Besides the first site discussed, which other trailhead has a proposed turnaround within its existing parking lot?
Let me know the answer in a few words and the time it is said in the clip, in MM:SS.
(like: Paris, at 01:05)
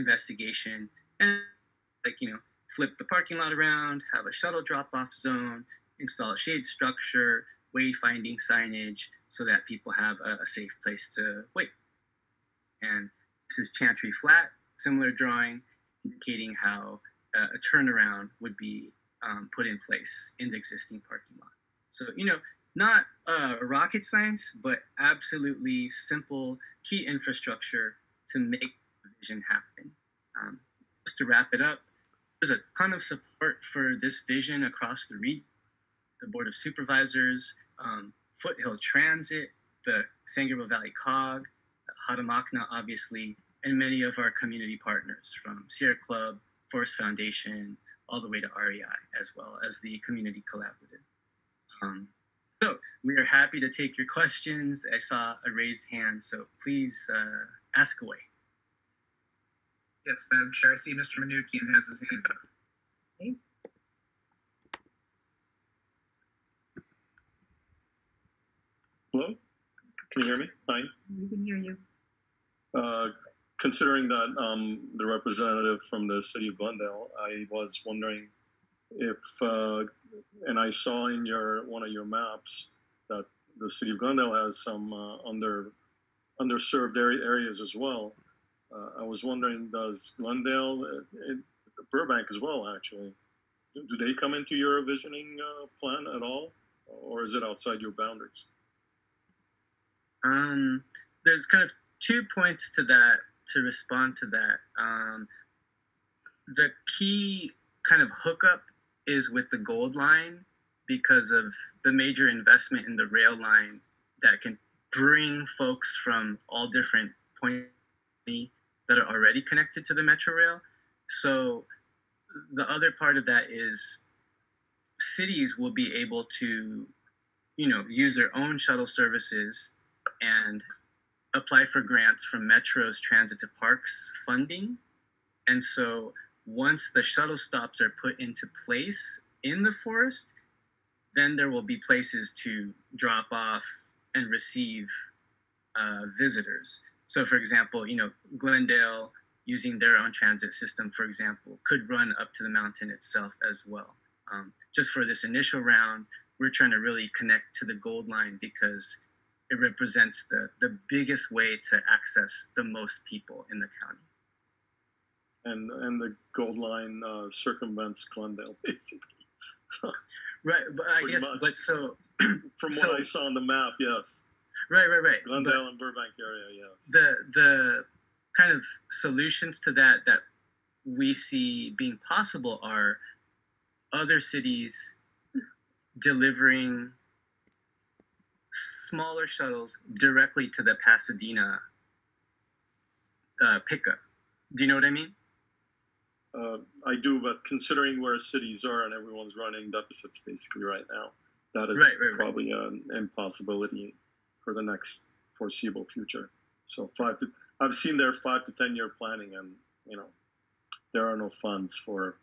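Chantry Flat, at 00:13.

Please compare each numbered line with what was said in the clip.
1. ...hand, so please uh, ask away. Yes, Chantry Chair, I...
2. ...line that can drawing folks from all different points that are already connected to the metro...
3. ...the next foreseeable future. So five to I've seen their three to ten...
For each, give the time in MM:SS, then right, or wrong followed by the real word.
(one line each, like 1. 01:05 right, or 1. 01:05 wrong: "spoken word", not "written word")
1. 00:55 wrong: "Madam", not "Chantry"
2. 01:53 wrong: "bring", not "drawing"
3. 03:24 wrong: "five", not "three".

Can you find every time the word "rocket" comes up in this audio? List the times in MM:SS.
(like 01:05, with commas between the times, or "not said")
00:23.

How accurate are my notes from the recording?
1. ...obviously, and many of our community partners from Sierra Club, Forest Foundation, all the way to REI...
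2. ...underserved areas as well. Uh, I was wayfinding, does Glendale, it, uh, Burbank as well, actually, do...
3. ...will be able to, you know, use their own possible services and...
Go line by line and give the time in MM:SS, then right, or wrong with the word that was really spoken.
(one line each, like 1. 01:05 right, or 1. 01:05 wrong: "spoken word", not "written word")
1. 00:42 right
2. 01:26 wrong: "wondering", not "wayfinding"
3. 02:05 wrong: "shuttle", not "possible".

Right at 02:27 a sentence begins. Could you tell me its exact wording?
So, for example, you know, Glendale, using their own transit system, for example, could run up to the mountain itself as well.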